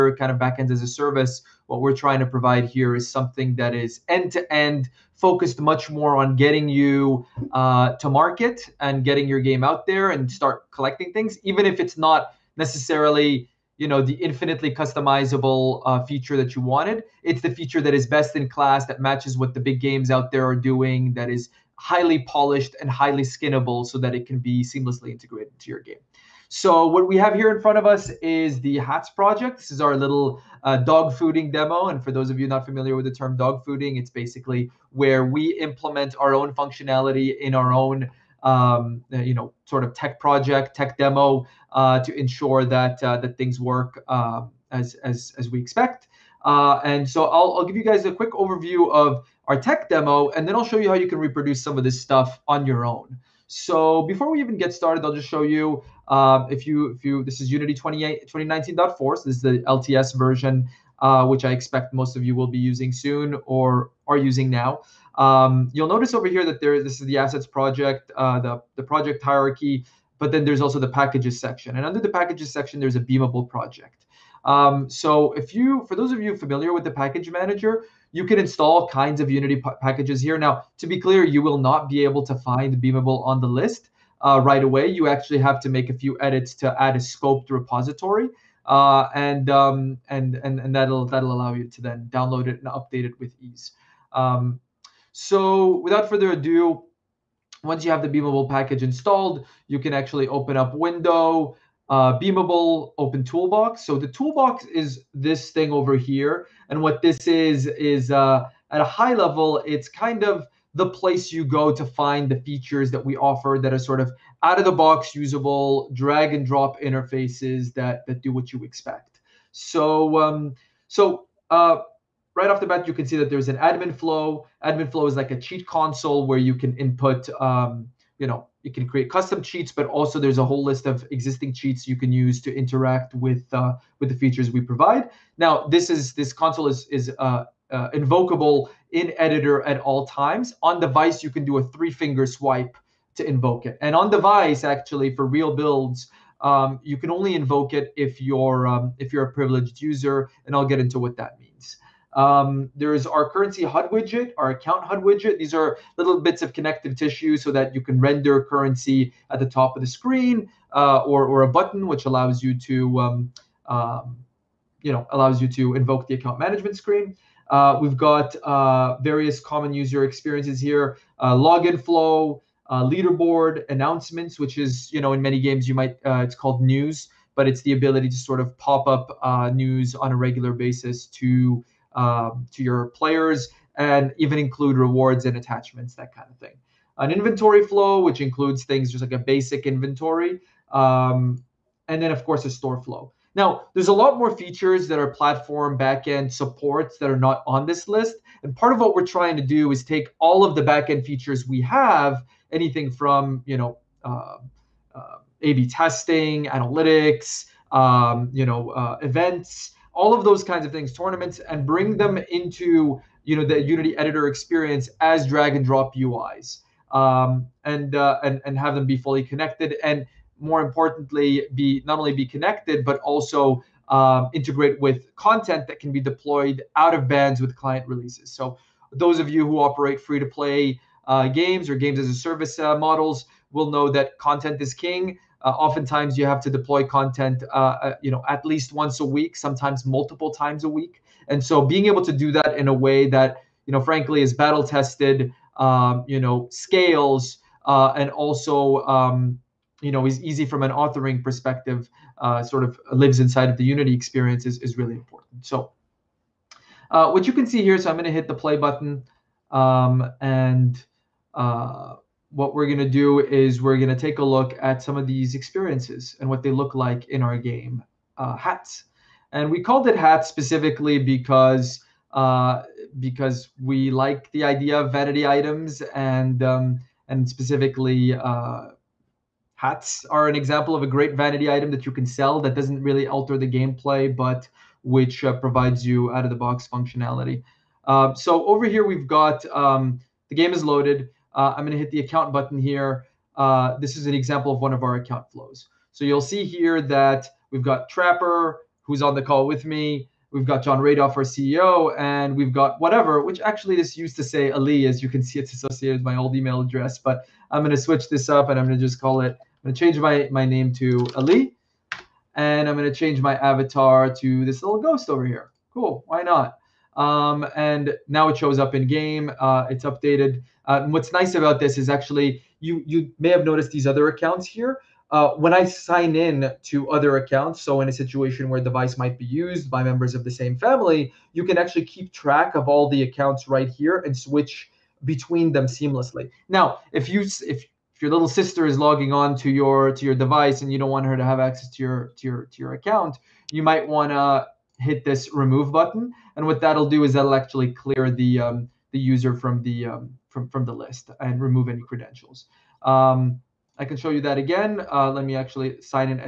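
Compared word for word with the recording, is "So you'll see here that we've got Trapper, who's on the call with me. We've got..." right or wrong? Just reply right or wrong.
right.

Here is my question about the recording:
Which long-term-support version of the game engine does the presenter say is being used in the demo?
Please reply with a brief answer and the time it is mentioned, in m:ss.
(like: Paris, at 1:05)
2019.4, at 0:58.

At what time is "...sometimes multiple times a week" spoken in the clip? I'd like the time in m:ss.
3:59.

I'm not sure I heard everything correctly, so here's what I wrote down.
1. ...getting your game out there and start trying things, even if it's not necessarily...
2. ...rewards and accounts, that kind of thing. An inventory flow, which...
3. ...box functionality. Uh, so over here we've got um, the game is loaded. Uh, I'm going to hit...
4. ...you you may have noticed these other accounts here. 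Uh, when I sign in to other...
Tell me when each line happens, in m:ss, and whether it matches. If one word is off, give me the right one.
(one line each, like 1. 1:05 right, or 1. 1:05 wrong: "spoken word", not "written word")
1. 0:09 wrong: "collecting", not "trying"
2. 3:04 wrong: "attachments", not "accounts"
3. 4:46 right
4. 5:22 right.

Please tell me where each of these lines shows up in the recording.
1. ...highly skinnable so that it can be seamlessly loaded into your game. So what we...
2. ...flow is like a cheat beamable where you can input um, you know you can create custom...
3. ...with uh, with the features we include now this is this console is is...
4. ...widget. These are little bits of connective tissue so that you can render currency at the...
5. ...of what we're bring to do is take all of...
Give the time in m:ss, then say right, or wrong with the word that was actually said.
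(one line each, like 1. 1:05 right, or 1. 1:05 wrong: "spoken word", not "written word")
1. 0:22 wrong: "integrated", not "loaded"
2. 2:04 wrong: "console", not "beamable"
3. 2:13 wrong: "provide", not "include"
4. 2:35 right
5. 3:18 wrong: "trying", not "bring".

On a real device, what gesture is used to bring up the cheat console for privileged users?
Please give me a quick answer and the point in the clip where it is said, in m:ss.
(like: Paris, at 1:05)
three finger swipe, at 2:21.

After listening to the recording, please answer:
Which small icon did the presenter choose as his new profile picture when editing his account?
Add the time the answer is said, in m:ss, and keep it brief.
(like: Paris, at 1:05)
ghost, at 5:14.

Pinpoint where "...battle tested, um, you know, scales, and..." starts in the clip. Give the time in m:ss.
4:04.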